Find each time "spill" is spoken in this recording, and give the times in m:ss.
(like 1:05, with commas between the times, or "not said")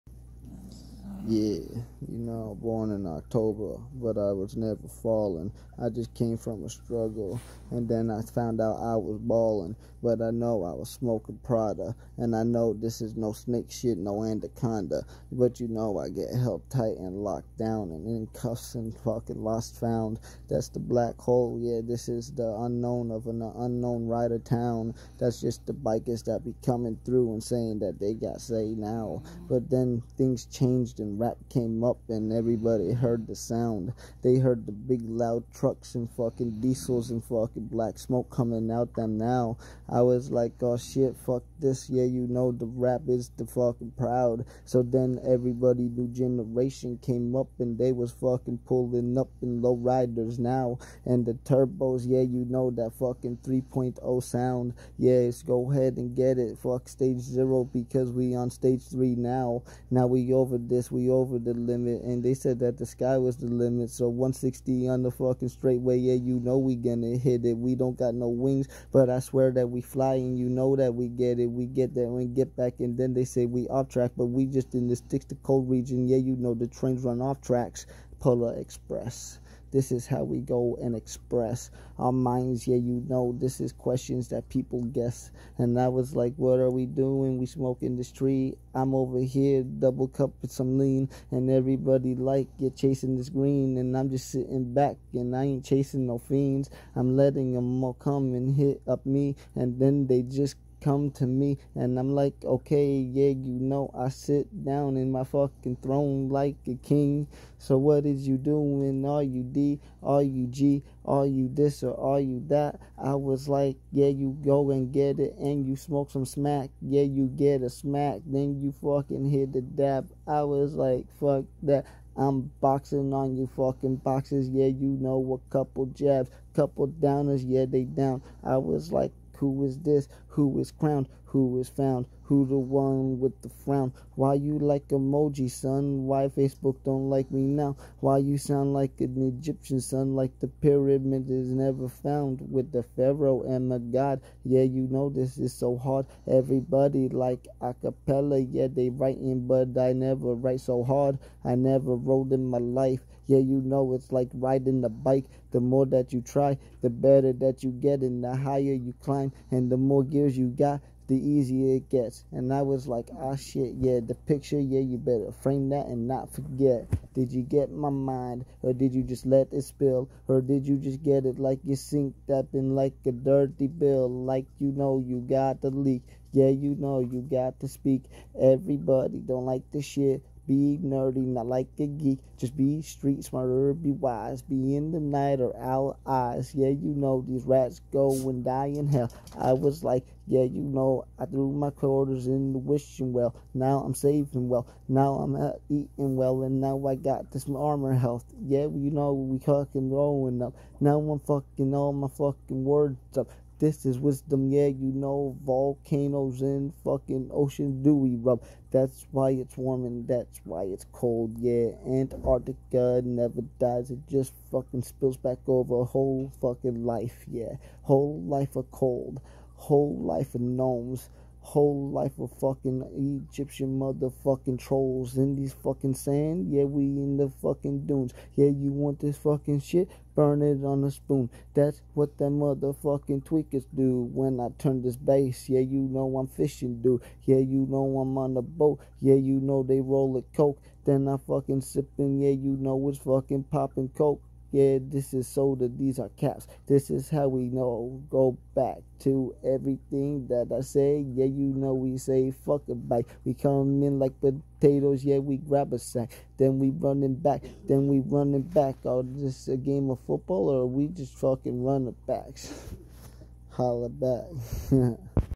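2:49, 3:34.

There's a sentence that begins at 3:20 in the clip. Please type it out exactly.
Now I'm fucking all my fucking words up.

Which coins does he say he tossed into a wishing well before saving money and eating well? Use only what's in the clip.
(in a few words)
quarters.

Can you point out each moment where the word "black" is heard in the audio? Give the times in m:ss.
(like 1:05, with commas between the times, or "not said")
0:20, 0:37.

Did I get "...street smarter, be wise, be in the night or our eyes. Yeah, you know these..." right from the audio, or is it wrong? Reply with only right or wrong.
right.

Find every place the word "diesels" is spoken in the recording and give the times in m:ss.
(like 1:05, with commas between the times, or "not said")
0:36.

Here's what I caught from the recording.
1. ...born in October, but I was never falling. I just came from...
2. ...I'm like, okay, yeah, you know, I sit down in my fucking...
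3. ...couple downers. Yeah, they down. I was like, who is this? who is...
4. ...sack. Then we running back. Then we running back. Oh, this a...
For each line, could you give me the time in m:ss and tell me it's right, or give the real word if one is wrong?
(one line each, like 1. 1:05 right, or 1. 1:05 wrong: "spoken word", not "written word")
1. 0:02 right
2. 1:41 right
3. 2:06 right
4. 4:15 right.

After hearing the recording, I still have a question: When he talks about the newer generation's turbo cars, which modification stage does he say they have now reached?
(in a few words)
stage three.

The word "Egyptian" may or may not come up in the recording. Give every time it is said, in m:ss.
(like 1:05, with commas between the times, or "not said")
2:19, 3:43.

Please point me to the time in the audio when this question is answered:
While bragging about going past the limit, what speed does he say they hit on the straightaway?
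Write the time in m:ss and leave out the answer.
1:04.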